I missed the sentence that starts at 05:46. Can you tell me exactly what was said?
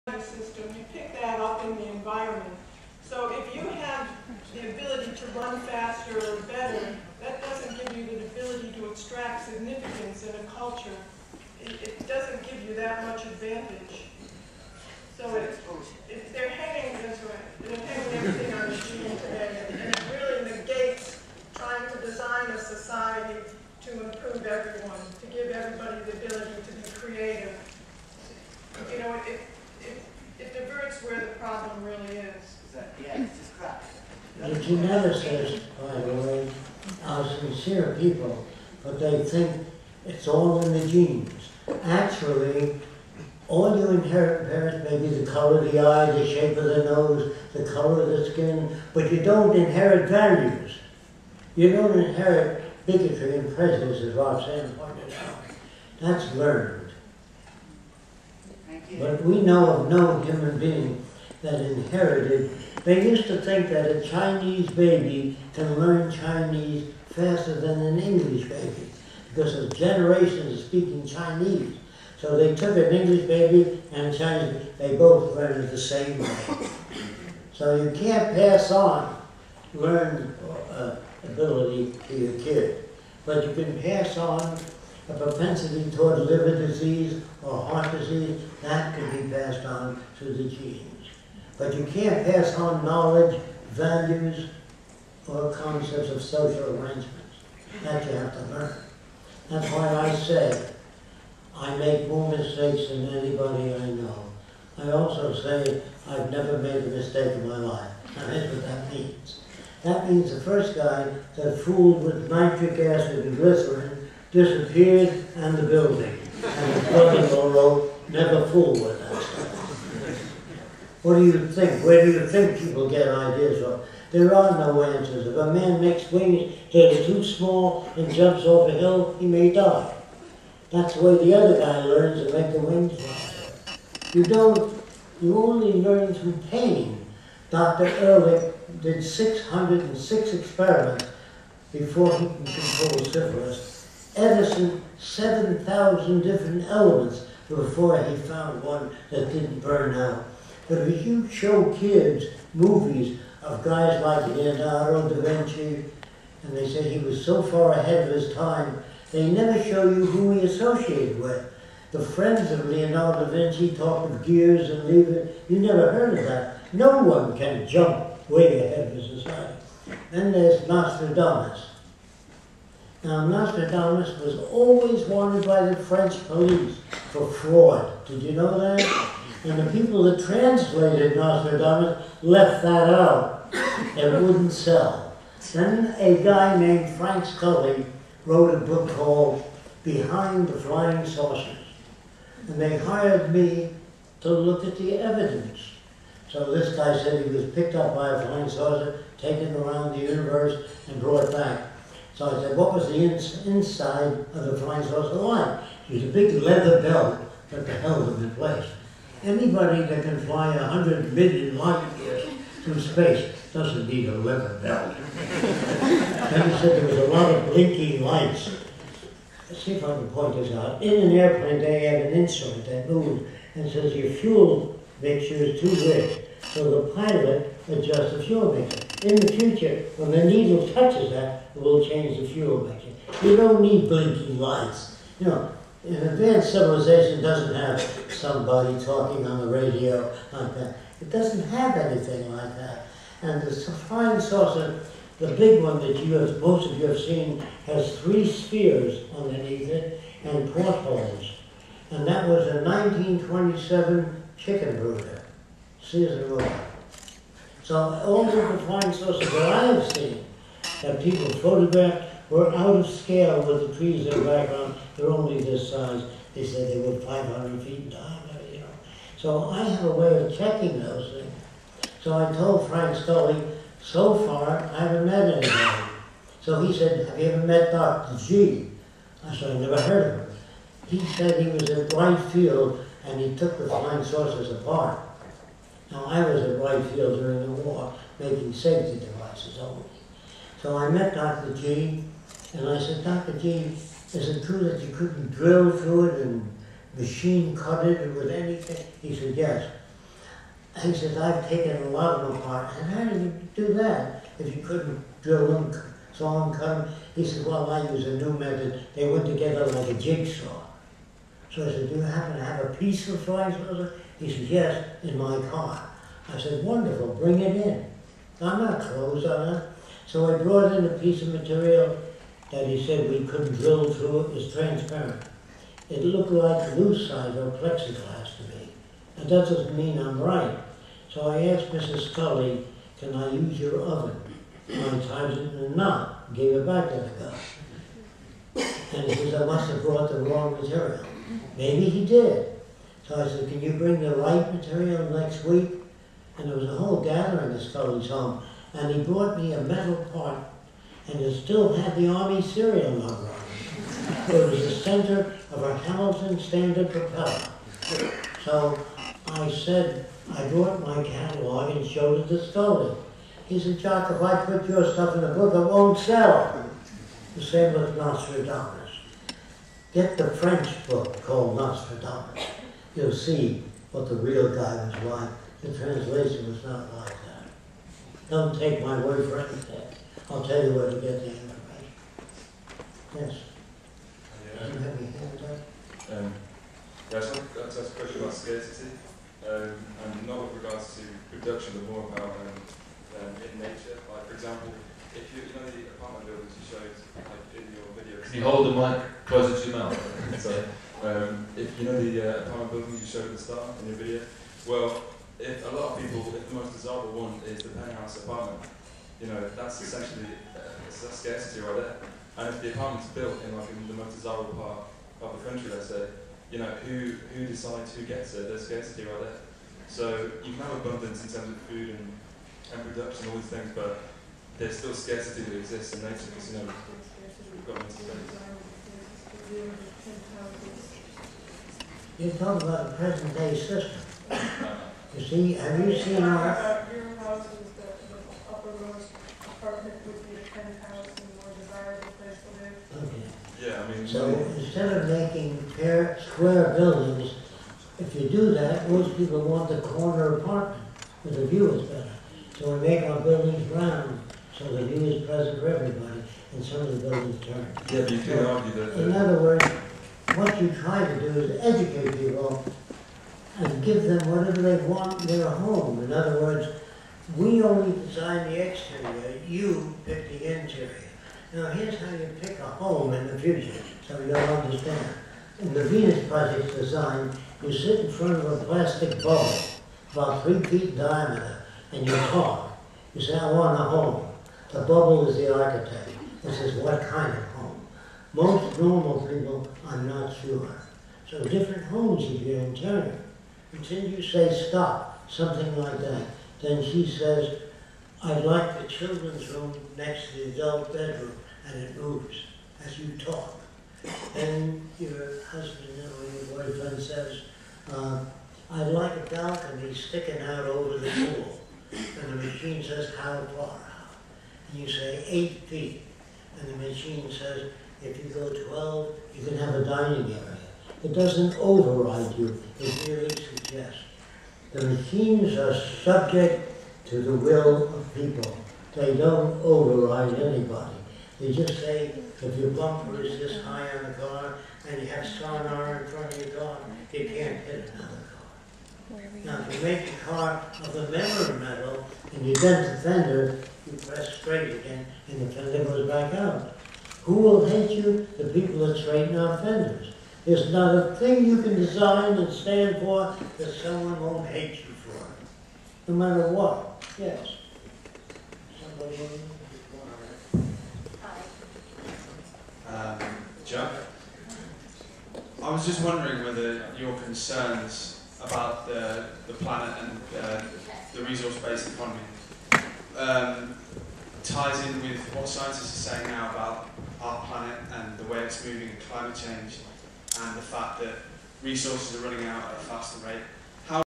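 And there was a whole gathering at Scully's home.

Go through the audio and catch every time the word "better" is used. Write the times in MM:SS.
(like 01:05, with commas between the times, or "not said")
00:06, 07:31.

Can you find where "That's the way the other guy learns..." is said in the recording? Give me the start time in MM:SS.
02:10.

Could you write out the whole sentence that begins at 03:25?
It was a big leather belt that held them in place.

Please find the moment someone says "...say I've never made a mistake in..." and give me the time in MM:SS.
01:45.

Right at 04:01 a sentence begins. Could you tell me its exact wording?
It doesn't have anything like that.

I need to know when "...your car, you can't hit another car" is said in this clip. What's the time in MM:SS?
08:56.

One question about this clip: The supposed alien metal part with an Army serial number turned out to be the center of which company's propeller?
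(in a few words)
Hamilton Standard.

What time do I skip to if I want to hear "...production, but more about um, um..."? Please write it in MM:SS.
06:31.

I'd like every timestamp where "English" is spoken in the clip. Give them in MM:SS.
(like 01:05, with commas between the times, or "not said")
01:07, 01:12.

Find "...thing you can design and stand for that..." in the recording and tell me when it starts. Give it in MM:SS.
09:11.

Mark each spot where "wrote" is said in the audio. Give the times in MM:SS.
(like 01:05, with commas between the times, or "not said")
01:57, 03:08.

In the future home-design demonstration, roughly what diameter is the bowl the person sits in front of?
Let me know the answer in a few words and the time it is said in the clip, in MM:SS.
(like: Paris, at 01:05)
3 feet, at 08:00.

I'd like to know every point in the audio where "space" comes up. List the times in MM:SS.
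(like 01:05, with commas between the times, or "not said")
03:32, 07:07.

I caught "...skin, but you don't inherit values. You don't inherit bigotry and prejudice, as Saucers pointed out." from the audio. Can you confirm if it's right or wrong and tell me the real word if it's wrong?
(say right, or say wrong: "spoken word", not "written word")
wrong: "Roxanne", not "Saucers".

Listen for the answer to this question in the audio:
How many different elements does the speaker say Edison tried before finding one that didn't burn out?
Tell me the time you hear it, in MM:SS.
02:24.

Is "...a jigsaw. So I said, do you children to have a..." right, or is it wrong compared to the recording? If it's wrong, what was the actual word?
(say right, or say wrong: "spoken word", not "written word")
wrong: "happen", not "children".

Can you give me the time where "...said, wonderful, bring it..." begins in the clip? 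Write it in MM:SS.
05:16.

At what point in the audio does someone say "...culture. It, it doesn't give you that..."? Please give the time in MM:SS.
00:10.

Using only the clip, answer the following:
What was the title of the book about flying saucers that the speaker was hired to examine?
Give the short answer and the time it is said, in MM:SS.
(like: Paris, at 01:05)
Behind the Flying Saucers, at 03:09.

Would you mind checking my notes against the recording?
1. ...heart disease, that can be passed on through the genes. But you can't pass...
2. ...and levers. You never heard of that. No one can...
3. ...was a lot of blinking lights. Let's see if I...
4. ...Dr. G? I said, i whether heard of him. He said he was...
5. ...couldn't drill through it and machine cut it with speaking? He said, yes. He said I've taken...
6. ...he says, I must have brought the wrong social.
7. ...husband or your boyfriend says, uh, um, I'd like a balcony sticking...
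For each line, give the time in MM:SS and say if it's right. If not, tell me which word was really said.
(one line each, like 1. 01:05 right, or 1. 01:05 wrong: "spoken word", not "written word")
1. 01:27 right
2. 02:44 right
3. 03:36 right
4. 04:37 wrong: "never", not "whether"
5. 04:54 wrong: "anything", not "speaking"
6. 05:39 wrong: "material", not "social"
7. 08:25 right.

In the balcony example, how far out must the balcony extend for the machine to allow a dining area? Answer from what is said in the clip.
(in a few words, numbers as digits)
12.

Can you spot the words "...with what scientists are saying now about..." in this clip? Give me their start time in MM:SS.
09:35.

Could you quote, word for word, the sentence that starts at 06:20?
I'll tell you where to get the information.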